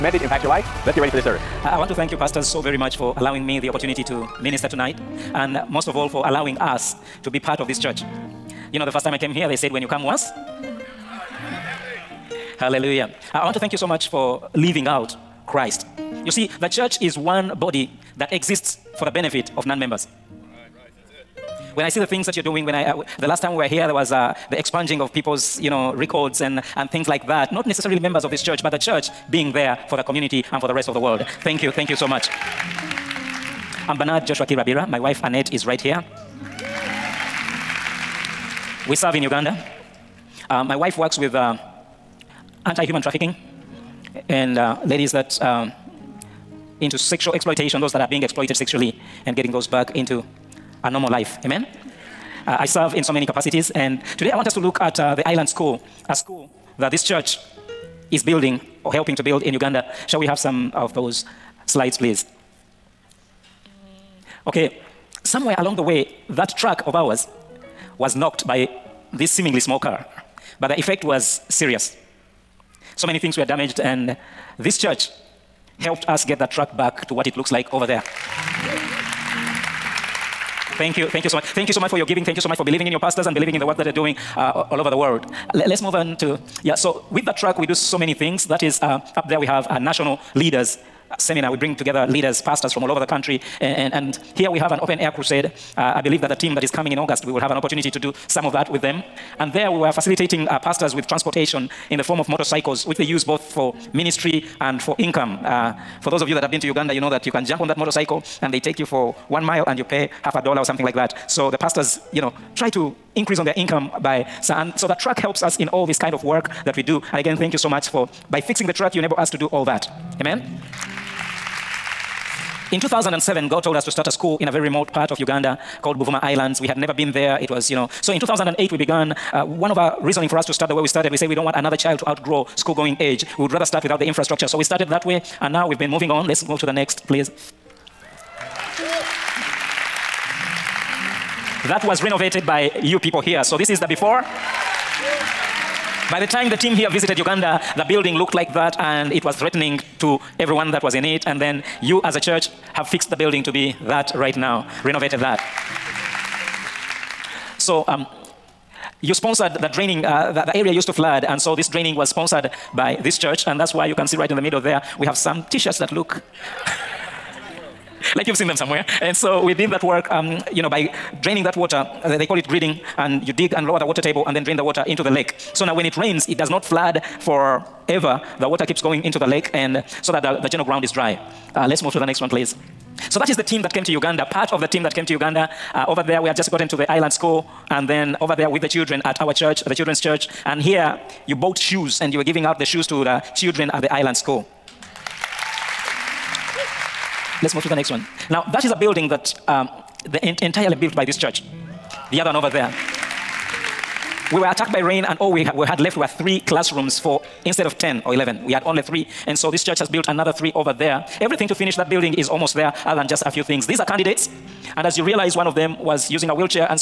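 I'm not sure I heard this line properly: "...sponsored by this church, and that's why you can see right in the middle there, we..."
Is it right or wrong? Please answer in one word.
right.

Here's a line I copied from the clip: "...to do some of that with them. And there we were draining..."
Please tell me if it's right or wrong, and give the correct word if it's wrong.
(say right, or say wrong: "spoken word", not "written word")
wrong: "facilitating", not "draining".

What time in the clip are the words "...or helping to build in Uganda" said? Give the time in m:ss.
0:58.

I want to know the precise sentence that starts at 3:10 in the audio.
And here you bought shoes and you were giving out the shoes to the children at the island school.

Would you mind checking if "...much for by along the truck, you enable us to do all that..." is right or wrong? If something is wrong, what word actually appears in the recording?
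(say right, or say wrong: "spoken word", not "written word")
wrong: "fixing", not "along".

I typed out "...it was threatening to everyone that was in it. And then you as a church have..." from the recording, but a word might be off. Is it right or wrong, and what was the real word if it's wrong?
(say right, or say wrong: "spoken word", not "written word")
right.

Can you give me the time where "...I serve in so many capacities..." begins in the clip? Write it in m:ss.
0:52.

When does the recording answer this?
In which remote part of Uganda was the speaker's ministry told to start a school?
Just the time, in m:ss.
2:05.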